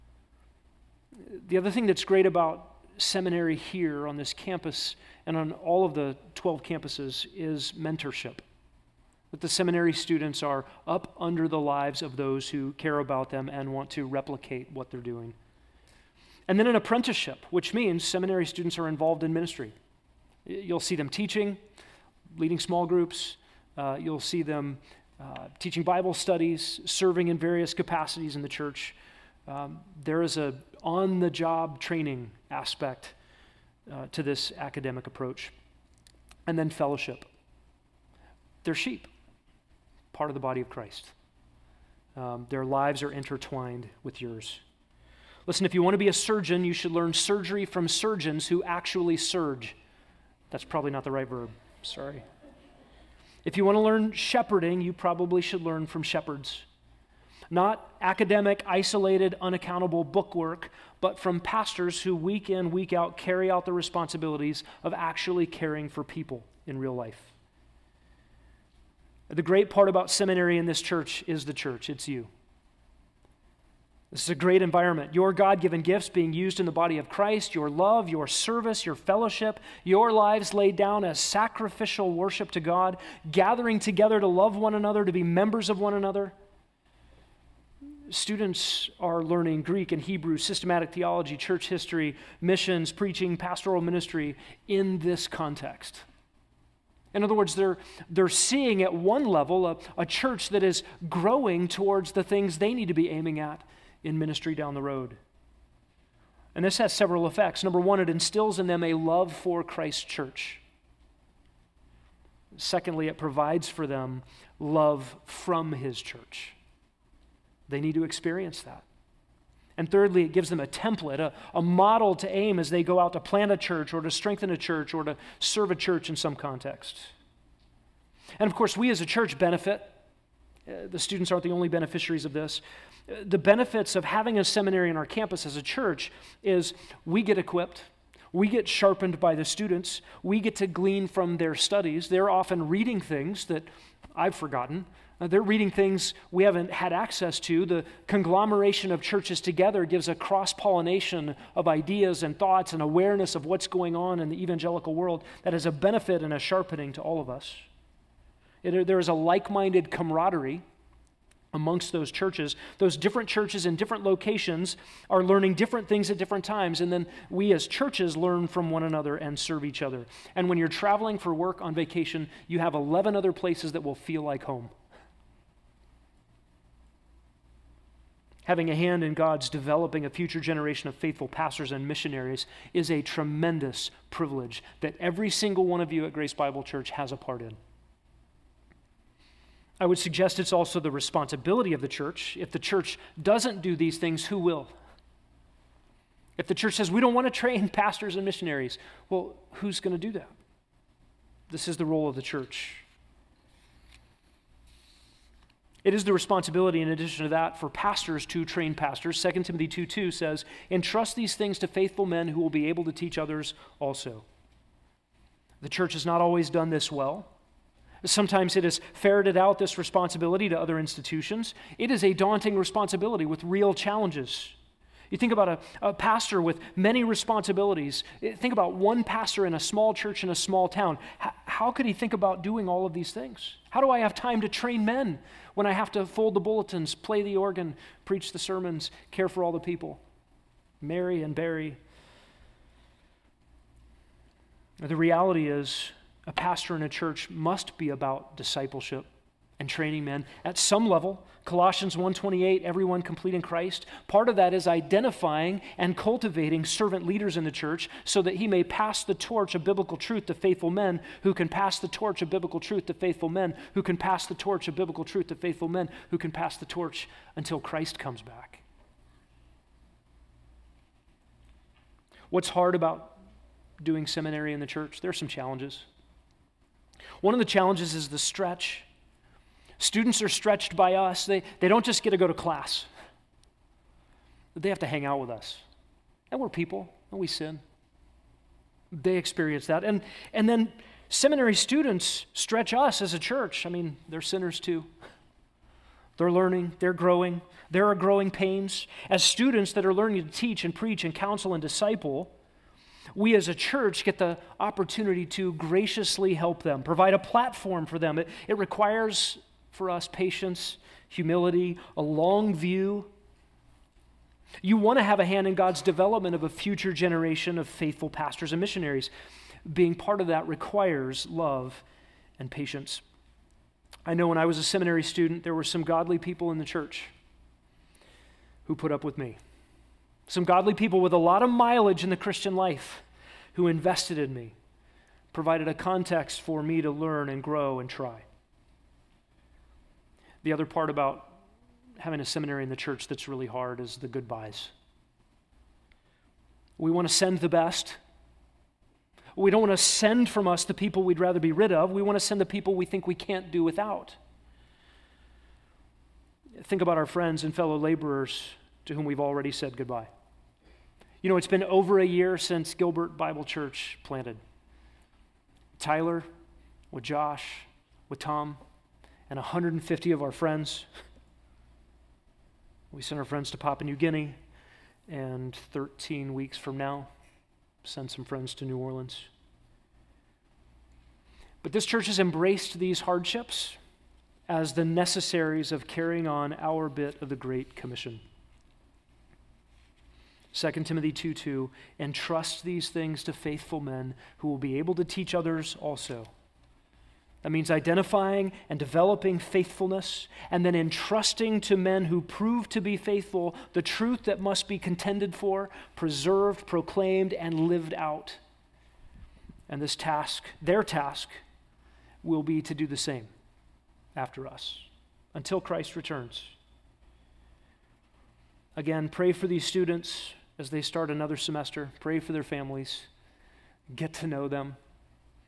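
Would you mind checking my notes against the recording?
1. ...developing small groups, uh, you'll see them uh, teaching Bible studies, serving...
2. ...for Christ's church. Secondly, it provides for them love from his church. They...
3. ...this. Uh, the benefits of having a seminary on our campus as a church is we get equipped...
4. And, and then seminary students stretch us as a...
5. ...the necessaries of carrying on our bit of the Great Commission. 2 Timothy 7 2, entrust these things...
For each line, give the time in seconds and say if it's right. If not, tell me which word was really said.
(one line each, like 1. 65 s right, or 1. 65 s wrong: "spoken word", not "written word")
1. 22 s wrong: "leading", not "developing"
2. 109 s right
3. 132 s right
4. 289 s right
5. 384 s wrong: "2", not "7".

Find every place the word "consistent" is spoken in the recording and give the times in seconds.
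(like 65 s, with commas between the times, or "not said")
not said.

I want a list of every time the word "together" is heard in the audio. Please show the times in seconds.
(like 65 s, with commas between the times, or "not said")
83 s, 149 s.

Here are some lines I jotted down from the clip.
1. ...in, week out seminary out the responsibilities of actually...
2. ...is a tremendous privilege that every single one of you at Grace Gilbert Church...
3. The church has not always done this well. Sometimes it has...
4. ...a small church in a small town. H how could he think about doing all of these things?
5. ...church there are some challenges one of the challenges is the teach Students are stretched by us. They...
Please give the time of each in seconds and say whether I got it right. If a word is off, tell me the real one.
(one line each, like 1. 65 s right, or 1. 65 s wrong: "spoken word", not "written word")
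1. 62 s wrong: "carry", not "seminary"
2. 182 s wrong: "Bible", not "Gilbert"
3. 215 s right
4. 229 s right
5. 274 s wrong: "stretch", not "teach".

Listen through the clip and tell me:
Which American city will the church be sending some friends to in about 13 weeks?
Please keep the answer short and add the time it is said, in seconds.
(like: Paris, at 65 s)
New Orleans, at 378 s.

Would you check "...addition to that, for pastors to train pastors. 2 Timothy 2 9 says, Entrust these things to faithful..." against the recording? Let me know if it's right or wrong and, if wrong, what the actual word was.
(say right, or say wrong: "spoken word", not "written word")
wrong: "2", not "9".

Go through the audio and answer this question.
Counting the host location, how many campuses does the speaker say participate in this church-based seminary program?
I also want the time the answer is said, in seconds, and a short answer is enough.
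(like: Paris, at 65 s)
12, at 6 s.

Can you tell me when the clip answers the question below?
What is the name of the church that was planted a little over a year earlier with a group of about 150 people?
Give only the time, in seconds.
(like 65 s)
362 s.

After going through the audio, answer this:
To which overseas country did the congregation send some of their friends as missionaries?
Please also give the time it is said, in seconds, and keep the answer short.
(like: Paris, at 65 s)
Papua New Guinea, at 373 s.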